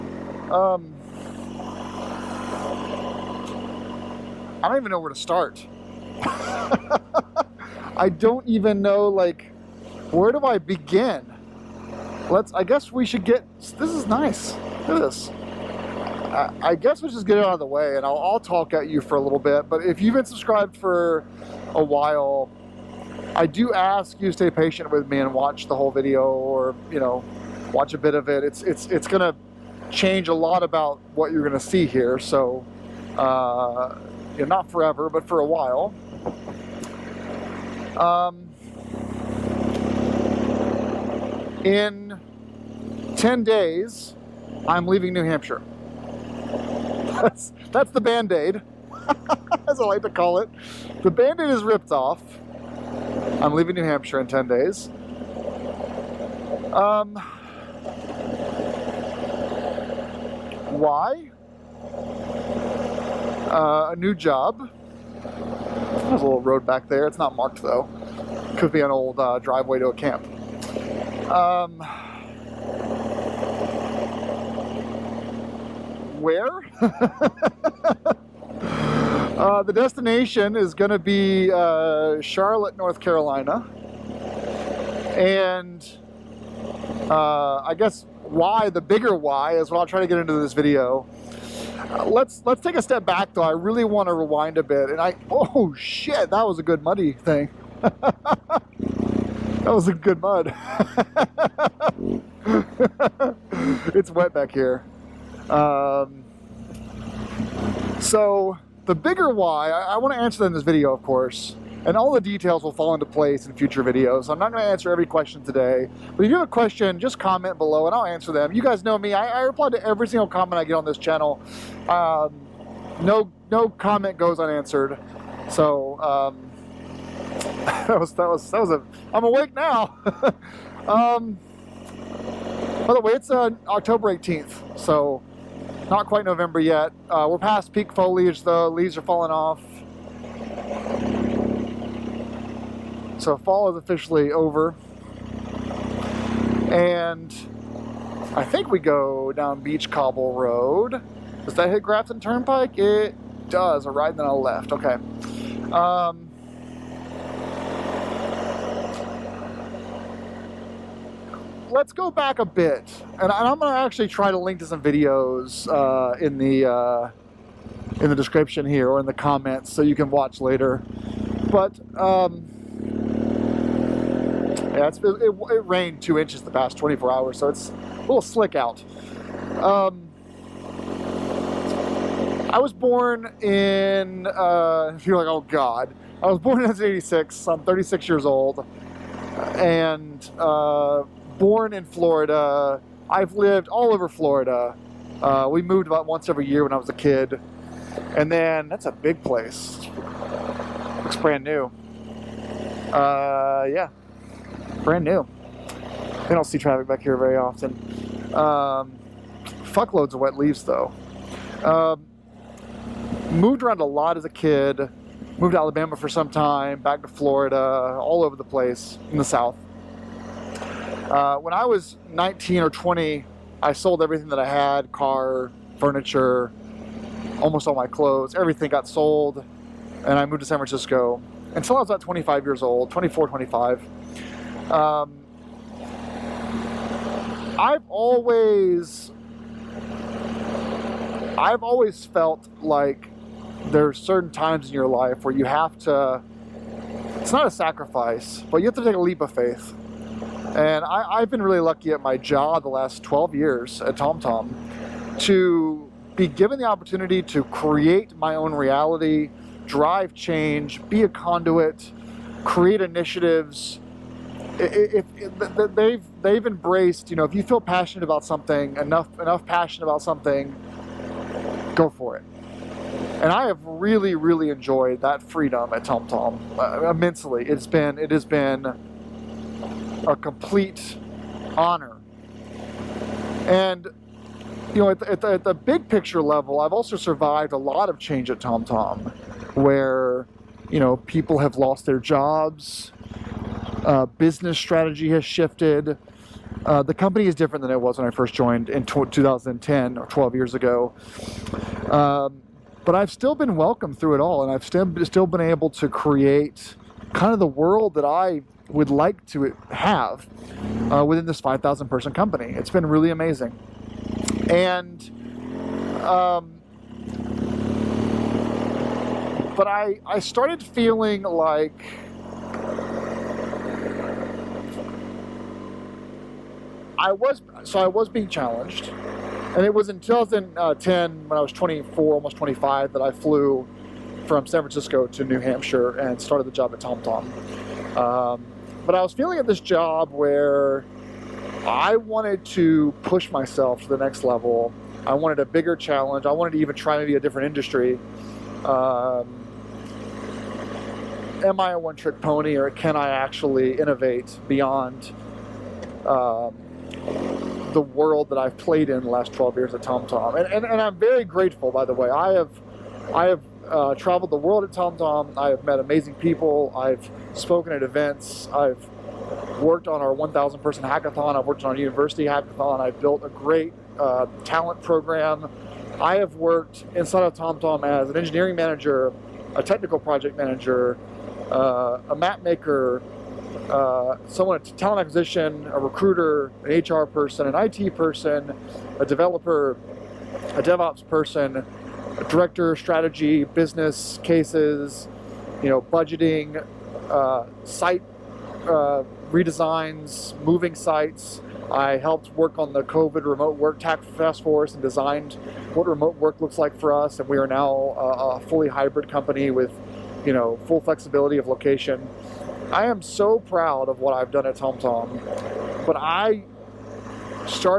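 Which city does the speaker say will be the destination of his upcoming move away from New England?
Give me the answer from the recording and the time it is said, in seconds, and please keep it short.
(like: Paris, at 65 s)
Charlotte, North Carolina, at 82 s.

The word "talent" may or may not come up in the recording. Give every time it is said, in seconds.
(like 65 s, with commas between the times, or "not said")
374 s, 384 s.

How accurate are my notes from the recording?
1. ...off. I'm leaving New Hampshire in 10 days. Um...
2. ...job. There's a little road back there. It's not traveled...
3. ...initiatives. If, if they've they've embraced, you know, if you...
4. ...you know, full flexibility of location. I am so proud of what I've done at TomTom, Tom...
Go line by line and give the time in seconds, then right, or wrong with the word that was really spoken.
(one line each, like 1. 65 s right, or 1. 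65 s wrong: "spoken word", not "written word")
1. 51 s right
2. 64 s wrong: "marked", not "traveled"
3. 262 s right
4. 410 s right.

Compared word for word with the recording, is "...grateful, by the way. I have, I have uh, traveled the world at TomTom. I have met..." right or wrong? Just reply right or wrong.
right.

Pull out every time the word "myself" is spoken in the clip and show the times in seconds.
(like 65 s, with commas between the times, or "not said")
343 s.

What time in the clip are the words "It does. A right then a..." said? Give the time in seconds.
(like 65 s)
152 s.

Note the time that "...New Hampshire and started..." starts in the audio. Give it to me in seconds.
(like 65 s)
335 s.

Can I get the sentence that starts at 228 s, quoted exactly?
Everything got sold, and I moved to San Francisco until I was about 25 years old 24, 25.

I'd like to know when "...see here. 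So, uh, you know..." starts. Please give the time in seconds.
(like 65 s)
31 s.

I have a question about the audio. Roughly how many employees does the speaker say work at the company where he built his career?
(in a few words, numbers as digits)
5,000.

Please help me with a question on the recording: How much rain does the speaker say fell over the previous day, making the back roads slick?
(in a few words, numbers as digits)
2 inches.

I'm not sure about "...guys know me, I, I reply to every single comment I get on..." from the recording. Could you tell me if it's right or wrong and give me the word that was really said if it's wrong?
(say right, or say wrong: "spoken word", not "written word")
right.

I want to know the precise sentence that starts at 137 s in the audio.
Uh, we're past peak foliage though.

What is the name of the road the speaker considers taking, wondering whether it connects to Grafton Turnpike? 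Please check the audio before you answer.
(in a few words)
Beach Cobble Road.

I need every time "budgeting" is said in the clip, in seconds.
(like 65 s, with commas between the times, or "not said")
395 s.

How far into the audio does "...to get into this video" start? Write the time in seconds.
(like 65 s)
90 s.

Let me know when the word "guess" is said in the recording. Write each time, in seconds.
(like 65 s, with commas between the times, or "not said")
12 s, 16 s, 87 s.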